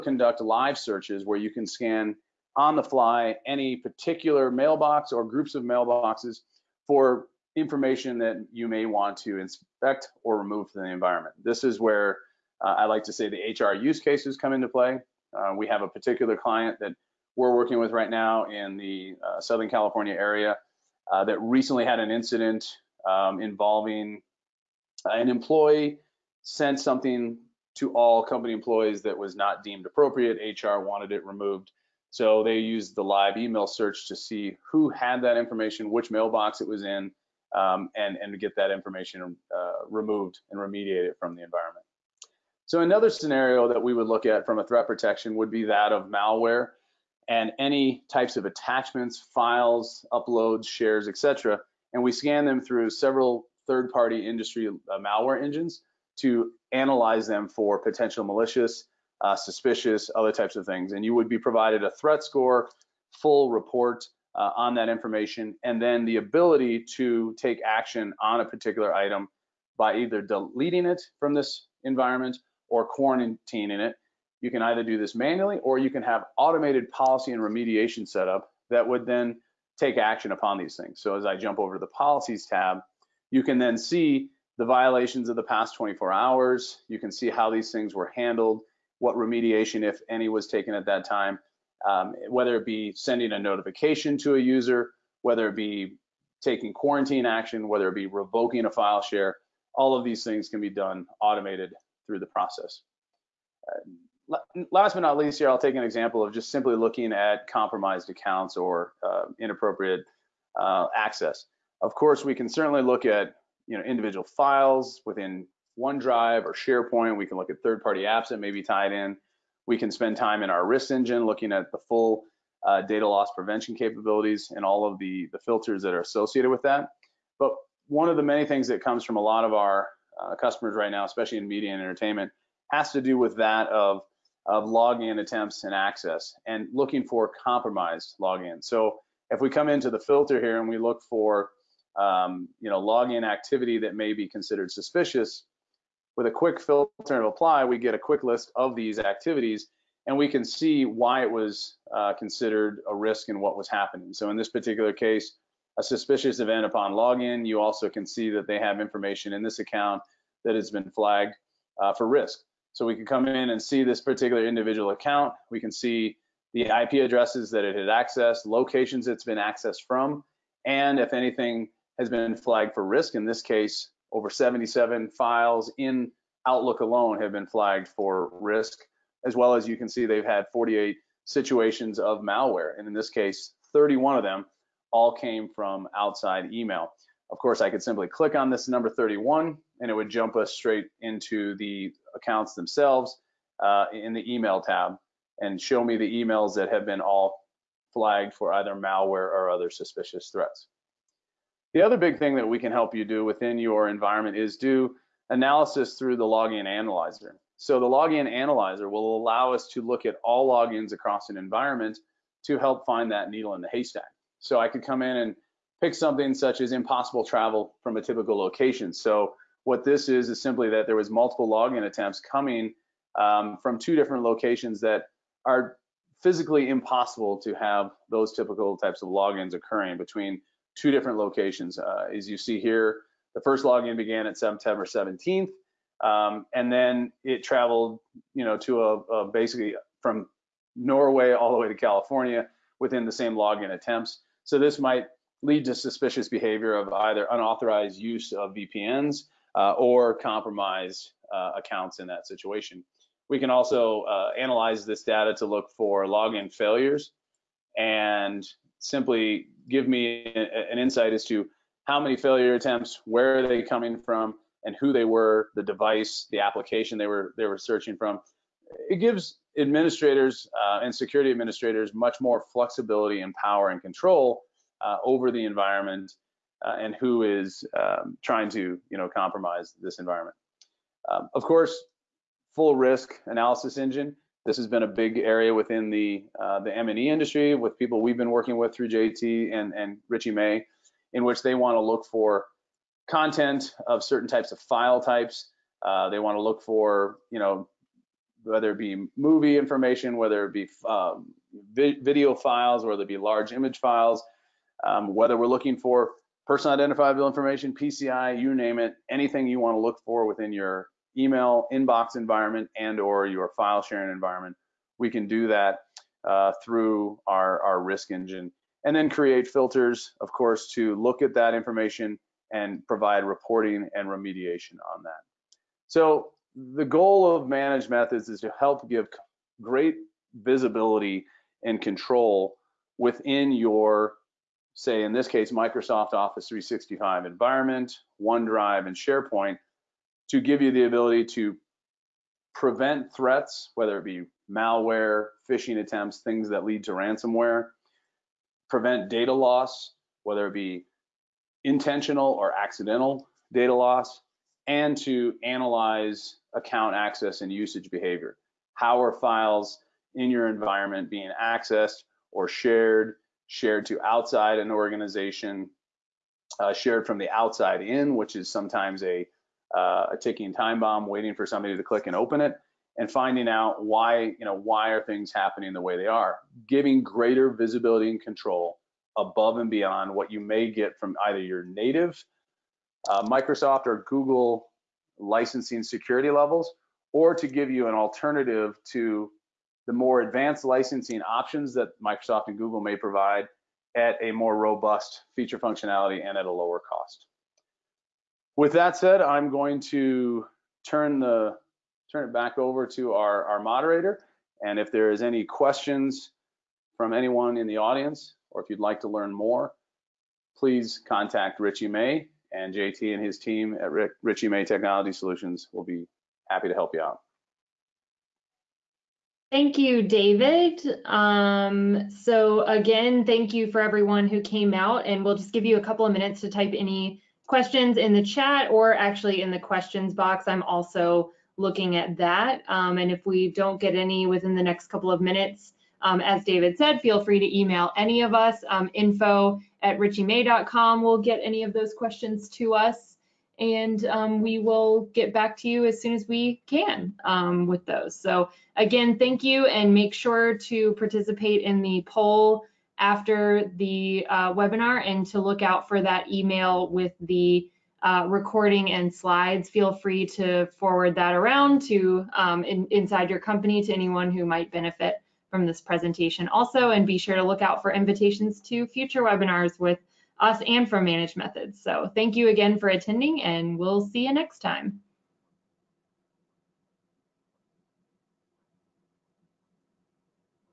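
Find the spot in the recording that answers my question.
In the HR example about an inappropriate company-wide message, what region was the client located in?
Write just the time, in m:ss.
0:19.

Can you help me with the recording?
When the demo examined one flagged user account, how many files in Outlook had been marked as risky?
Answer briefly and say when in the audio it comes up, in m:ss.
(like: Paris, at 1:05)
77, at 2:54.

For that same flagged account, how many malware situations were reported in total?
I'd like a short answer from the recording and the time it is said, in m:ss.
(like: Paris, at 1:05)
48, at 3:00.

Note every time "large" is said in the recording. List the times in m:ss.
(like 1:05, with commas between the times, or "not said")
5:03.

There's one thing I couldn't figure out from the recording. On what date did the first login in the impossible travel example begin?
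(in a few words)
September 17.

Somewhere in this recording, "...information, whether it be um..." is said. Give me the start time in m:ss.
4:59.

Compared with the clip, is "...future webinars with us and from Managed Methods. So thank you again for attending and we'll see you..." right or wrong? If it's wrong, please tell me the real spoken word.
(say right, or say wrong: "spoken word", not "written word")
right.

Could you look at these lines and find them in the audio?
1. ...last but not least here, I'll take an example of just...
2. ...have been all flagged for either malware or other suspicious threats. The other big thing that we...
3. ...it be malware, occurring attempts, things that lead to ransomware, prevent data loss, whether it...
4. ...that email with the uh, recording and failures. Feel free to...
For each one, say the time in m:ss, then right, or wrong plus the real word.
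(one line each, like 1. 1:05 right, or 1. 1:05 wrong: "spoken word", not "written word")
1. 1:44 right
2. 3:16 right
3. 5:43 wrong: "phishing", not "occurring"
4. 7:36 wrong: "slides", not "failures".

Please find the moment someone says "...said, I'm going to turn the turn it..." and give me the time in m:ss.
6:38.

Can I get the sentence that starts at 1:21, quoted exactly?
So as I jump over to the policies tab, you can then see the violations of the past 24 hours.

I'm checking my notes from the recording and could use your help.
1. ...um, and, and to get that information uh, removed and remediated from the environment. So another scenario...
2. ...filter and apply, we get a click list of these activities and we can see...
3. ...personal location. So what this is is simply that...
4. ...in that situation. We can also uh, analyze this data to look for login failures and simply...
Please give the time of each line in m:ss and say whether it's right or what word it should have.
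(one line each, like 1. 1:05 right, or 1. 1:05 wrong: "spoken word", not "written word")
1. 0:37 right
2. 2:26 wrong: "quick", not "click"
3. 3:38 wrong: "typical", not "personal"
4. 4:11 right.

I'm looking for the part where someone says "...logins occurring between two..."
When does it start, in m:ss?
3:49.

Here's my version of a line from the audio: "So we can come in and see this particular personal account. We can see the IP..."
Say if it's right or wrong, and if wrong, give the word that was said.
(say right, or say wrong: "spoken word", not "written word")
wrong: "individual", not "personal".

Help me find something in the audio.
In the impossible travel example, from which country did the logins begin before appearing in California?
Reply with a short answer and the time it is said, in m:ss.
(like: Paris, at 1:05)
Norway, at 4:00.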